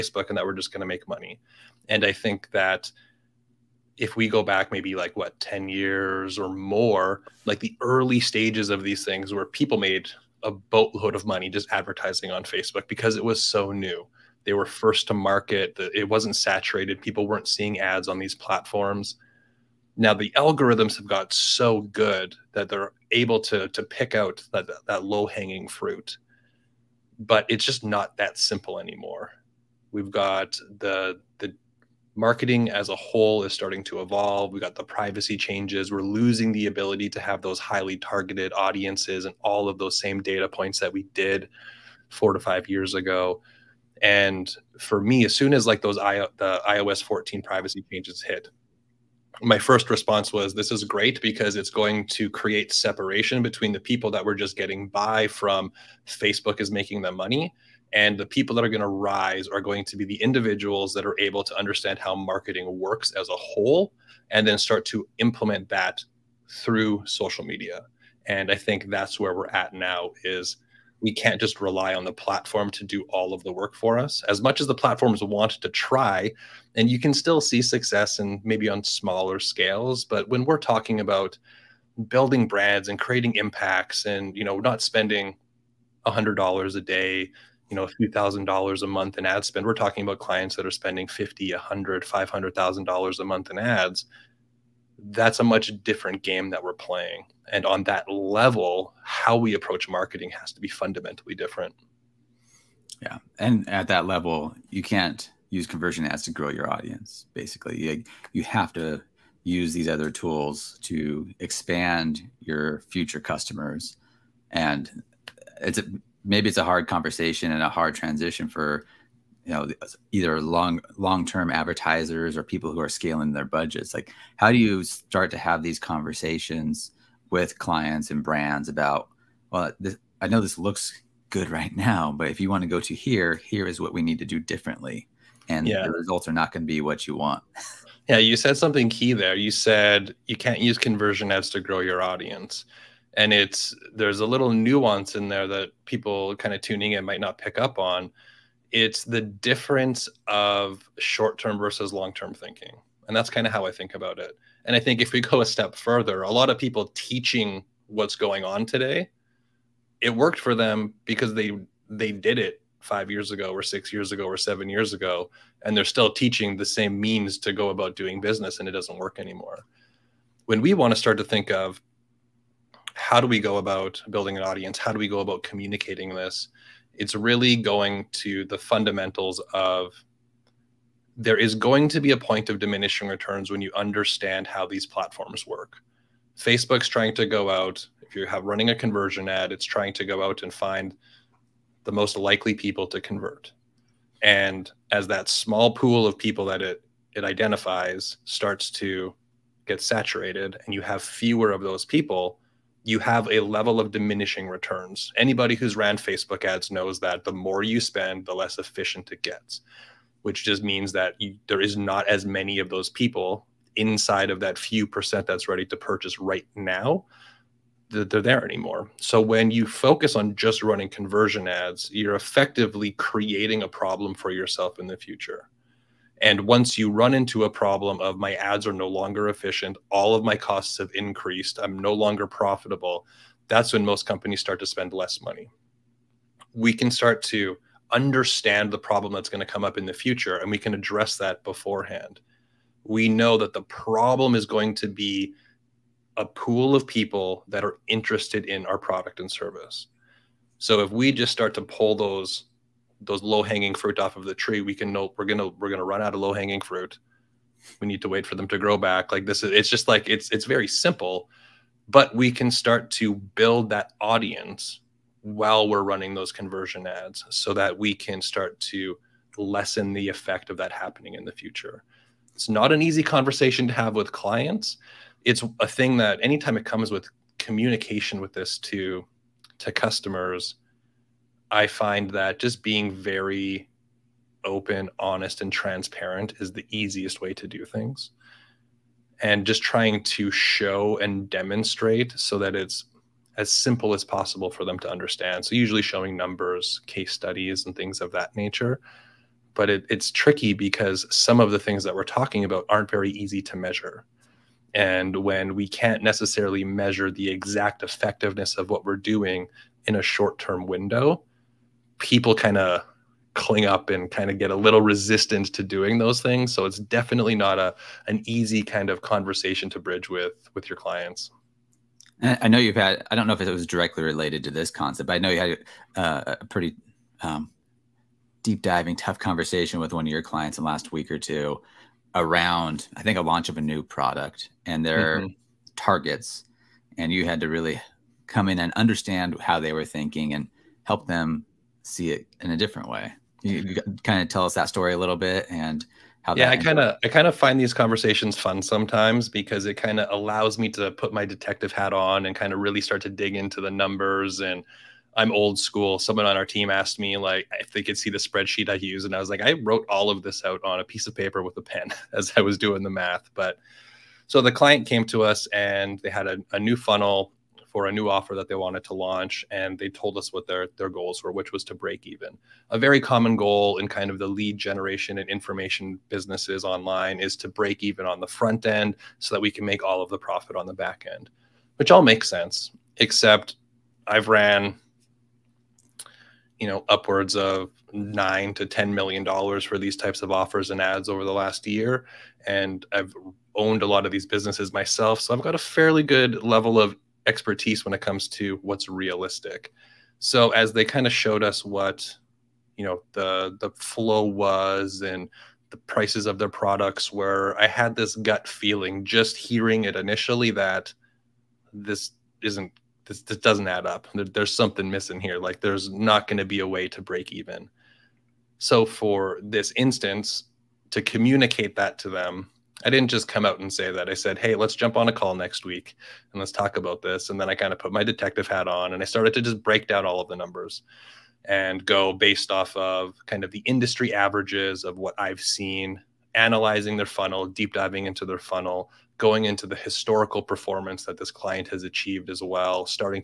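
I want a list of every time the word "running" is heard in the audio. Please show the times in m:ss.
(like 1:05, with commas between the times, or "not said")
3:08, 3:40, 4:25.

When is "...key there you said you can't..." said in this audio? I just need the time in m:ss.
2:18.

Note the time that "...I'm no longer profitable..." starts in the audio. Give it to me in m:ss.
3:51.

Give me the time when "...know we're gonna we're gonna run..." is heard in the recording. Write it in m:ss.
4:14.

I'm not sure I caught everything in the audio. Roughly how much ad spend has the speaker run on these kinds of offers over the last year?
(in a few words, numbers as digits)
$9 to $10 million.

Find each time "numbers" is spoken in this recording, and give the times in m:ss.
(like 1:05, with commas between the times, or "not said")
4:56, 5:53, 7:10.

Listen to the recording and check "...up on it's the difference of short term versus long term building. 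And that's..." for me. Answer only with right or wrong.
wrong.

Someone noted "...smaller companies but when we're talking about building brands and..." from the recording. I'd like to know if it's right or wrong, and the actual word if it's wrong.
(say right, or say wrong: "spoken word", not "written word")
wrong: "scales", not "companies".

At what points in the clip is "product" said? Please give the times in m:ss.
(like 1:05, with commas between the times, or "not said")
4:08, 5:33, 6:46.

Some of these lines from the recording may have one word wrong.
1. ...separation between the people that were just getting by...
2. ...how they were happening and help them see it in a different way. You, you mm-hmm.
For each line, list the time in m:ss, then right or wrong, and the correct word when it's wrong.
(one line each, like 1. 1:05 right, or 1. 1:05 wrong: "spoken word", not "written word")
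1. 0:52 right
2. 5:39 wrong: "thinking", not "happening".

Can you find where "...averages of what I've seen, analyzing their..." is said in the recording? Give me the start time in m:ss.
7:14.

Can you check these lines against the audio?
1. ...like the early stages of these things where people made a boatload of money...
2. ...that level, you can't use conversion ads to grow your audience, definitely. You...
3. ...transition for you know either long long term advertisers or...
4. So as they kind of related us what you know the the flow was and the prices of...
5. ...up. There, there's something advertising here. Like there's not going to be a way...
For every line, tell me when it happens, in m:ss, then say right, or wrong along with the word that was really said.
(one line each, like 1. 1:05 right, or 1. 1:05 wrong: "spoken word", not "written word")
1. 0:07 right
2. 1:43 wrong: "basically", not "definitely"
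3. 1:57 right
4. 6:40 wrong: "showed", not "related"
5. 6:53 wrong: "missing", not "advertising".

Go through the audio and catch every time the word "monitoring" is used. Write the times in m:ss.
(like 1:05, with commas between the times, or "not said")
not said.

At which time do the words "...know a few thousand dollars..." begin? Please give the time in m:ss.
1:27.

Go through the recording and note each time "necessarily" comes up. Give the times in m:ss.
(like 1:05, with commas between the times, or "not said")
5:06.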